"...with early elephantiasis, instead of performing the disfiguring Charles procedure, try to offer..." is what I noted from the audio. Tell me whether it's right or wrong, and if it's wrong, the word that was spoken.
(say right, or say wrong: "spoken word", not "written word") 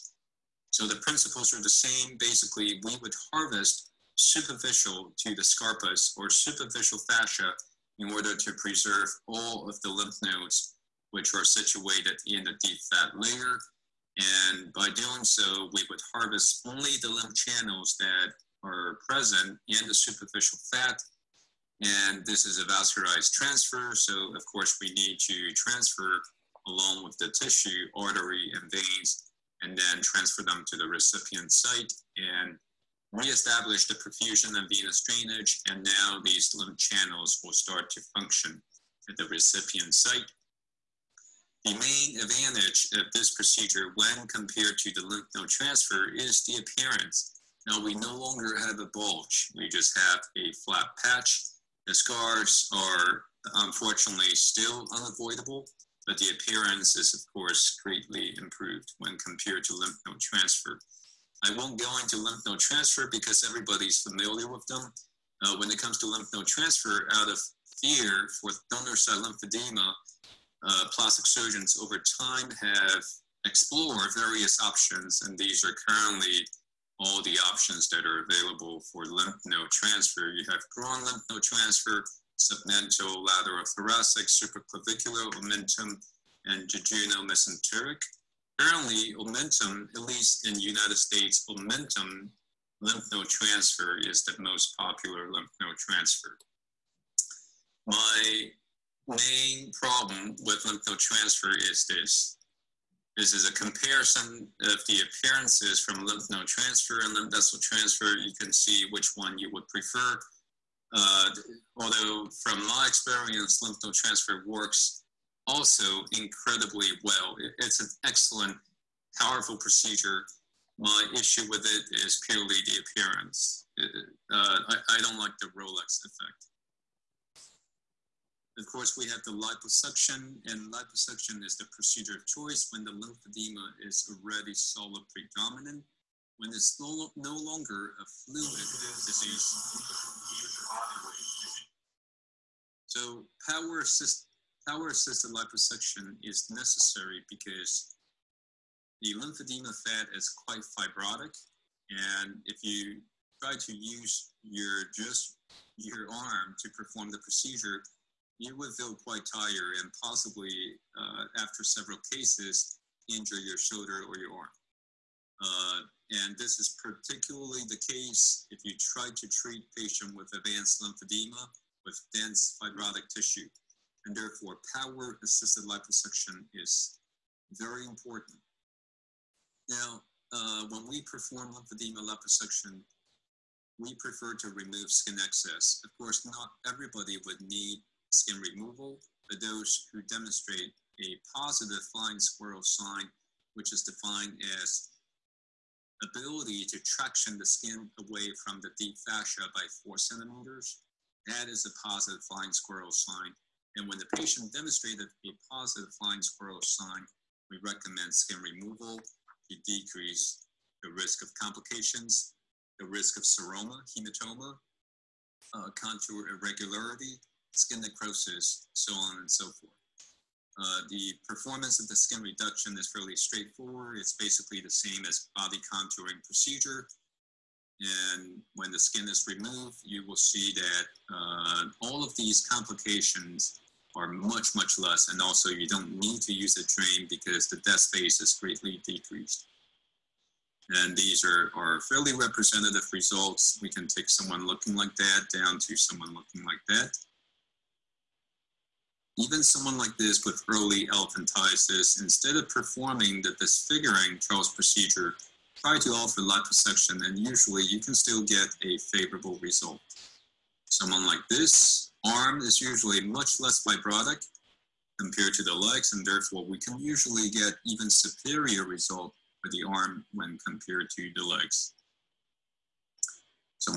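right.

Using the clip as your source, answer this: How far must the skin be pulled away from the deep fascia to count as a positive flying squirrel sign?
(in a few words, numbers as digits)
4 centimeters.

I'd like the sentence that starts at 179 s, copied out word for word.
Now, uh, when we perform lymphedema liposuction, we prefer to remove skin excess.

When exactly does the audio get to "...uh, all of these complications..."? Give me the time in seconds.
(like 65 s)
231 s.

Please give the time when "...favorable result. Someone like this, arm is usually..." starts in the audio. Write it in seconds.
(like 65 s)
258 s.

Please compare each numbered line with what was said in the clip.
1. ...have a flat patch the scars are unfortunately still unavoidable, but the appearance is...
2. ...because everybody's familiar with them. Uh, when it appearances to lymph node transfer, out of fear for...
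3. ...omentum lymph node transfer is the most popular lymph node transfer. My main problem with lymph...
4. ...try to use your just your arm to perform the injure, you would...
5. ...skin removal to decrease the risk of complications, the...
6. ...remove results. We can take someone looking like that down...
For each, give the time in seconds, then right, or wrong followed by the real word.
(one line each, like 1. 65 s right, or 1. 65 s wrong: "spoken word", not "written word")
1. 49 s right
2. 63 s wrong: "comes", not "appearances"
3. 91 s right
4. 153 s wrong: "procedure", not "injure"
5. 208 s right
6. 242 s wrong: "representative", not "remove".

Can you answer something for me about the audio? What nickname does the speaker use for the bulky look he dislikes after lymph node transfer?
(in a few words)
Rolex effect.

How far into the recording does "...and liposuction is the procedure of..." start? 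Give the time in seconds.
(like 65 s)
130 s.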